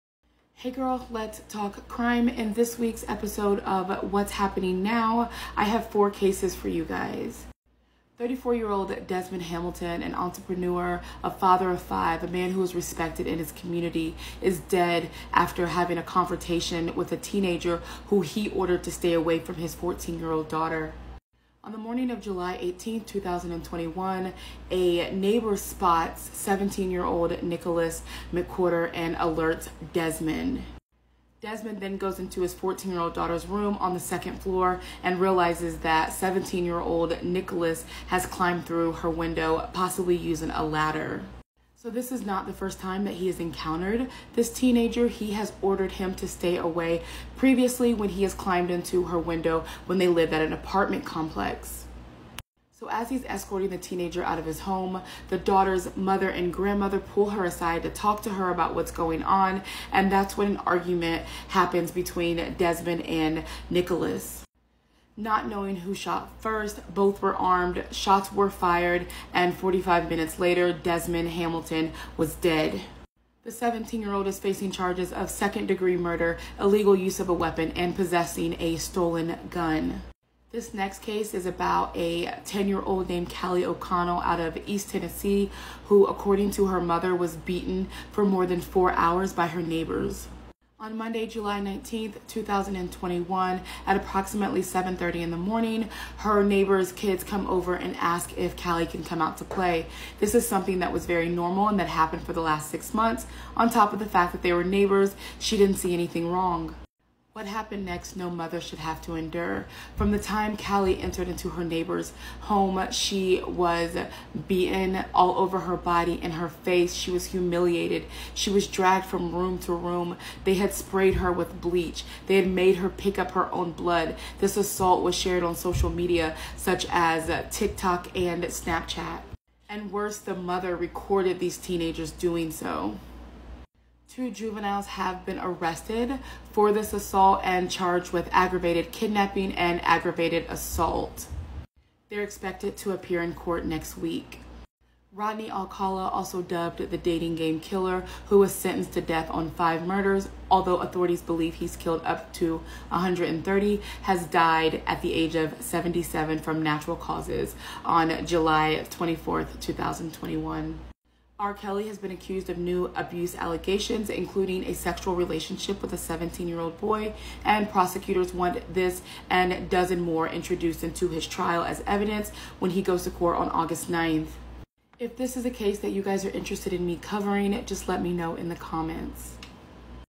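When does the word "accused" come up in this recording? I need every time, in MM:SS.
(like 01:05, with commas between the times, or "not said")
02:42.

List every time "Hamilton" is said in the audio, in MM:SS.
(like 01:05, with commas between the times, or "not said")
00:09, 01:11.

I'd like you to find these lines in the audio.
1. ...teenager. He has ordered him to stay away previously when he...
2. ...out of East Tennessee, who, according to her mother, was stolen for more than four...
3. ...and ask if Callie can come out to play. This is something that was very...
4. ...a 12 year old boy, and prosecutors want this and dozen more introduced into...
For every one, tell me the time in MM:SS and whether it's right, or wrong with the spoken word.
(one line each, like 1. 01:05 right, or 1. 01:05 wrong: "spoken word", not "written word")
1. 00:44 right
2. 01:24 wrong: "beaten", not "stolen"
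3. 01:37 right
4. 02:45 wrong: "17", not "12".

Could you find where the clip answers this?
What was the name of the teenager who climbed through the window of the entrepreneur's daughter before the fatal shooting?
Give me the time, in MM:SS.
00:27.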